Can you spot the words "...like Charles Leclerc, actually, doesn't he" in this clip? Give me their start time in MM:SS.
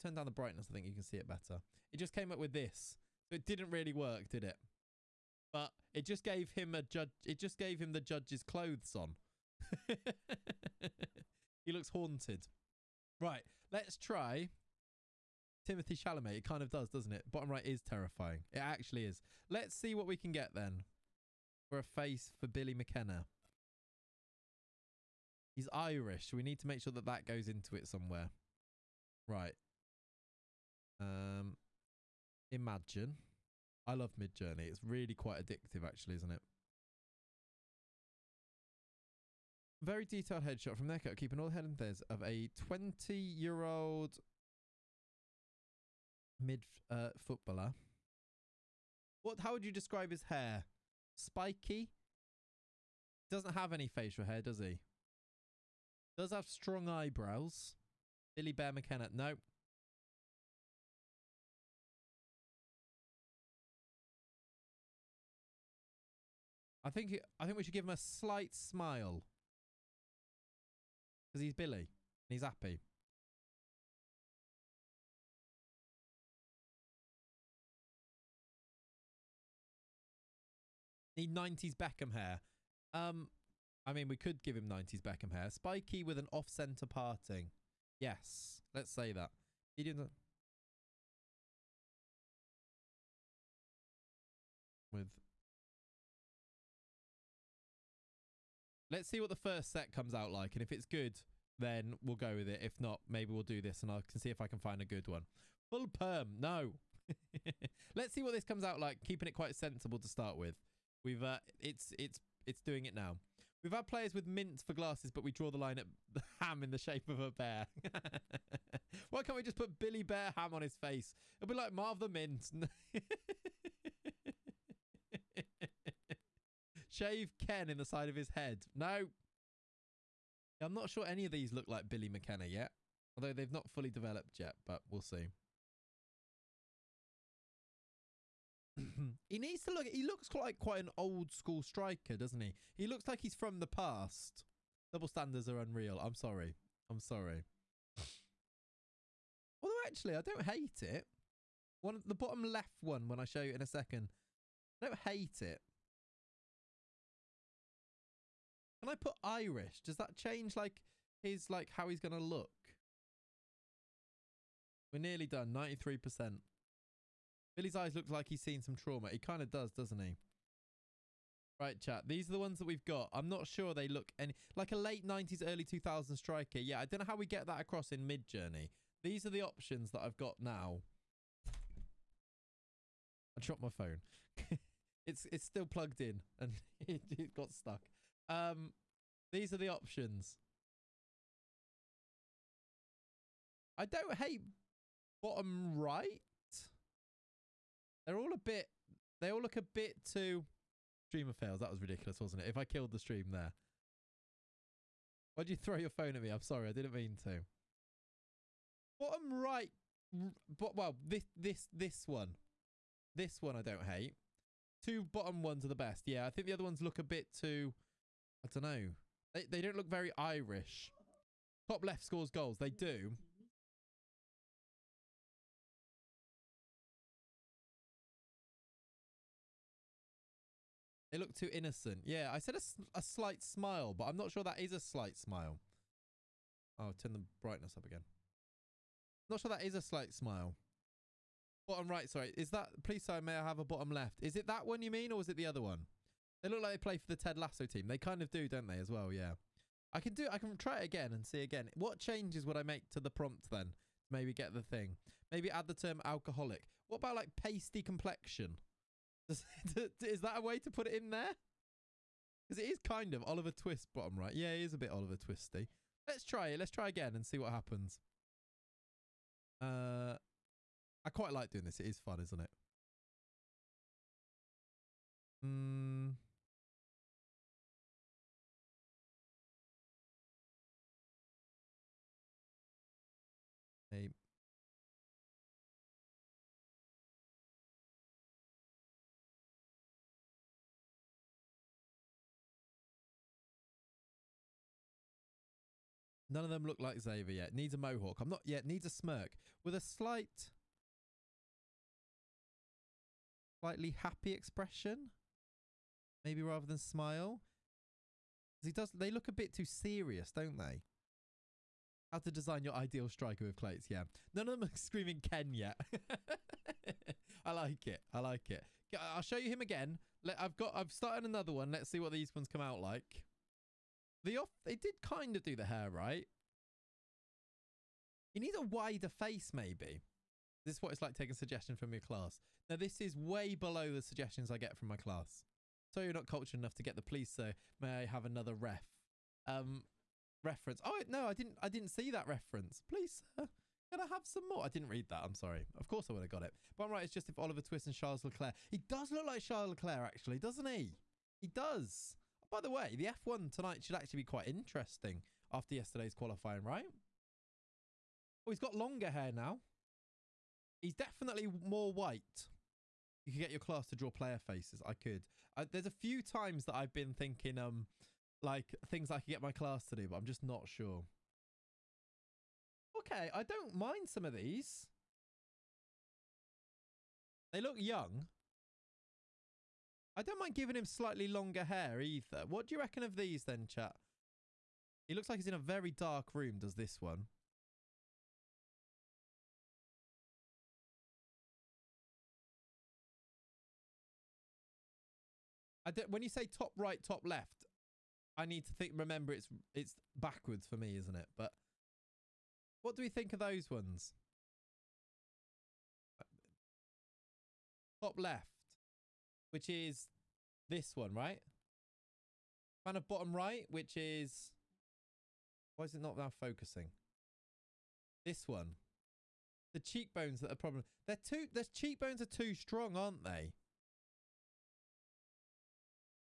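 05:49.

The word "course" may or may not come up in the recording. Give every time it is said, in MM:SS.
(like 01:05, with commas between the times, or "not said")
05:45.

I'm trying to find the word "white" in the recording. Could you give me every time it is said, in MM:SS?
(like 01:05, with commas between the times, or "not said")
06:01.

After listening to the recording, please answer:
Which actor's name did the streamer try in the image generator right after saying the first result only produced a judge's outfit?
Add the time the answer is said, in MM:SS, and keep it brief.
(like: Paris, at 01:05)
Timothée Chalamet, at 00:15.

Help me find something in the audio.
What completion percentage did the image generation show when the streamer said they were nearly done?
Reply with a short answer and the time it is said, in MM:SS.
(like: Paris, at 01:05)
93%, at 02:45.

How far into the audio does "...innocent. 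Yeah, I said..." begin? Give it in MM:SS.
03:51.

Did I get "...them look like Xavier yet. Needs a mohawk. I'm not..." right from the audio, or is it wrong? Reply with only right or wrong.
right.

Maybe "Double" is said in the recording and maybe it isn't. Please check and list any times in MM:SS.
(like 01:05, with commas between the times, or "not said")
02:24.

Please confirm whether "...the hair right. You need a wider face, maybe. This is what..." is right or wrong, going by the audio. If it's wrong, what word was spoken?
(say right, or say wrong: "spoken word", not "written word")
right.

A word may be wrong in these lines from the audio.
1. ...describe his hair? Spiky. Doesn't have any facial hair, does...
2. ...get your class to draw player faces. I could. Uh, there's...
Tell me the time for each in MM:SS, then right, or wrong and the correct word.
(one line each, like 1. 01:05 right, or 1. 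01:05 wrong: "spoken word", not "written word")
1. 00:49 right
2. 06:03 right.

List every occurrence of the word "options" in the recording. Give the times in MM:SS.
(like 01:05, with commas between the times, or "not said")
02:59, 03:09.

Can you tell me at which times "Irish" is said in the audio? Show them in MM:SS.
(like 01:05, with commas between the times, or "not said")
00:25, 02:39, 03:40.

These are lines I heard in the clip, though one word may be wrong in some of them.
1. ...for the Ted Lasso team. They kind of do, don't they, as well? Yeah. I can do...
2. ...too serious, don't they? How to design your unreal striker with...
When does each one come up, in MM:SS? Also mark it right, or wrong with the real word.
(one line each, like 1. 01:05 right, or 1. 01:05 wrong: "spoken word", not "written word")
1. 04:06 right
2. 05:09 wrong: "ideal", not "unreal".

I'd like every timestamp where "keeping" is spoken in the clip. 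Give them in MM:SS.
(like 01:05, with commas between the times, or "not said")
00:41, 01:49.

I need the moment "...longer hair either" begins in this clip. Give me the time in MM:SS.
06:21.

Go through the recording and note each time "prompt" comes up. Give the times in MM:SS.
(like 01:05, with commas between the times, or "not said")
04:13.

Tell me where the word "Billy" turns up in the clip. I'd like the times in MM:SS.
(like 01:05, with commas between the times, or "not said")
00:22, 00:58, 01:11, 01:59, 02:11, 02:47.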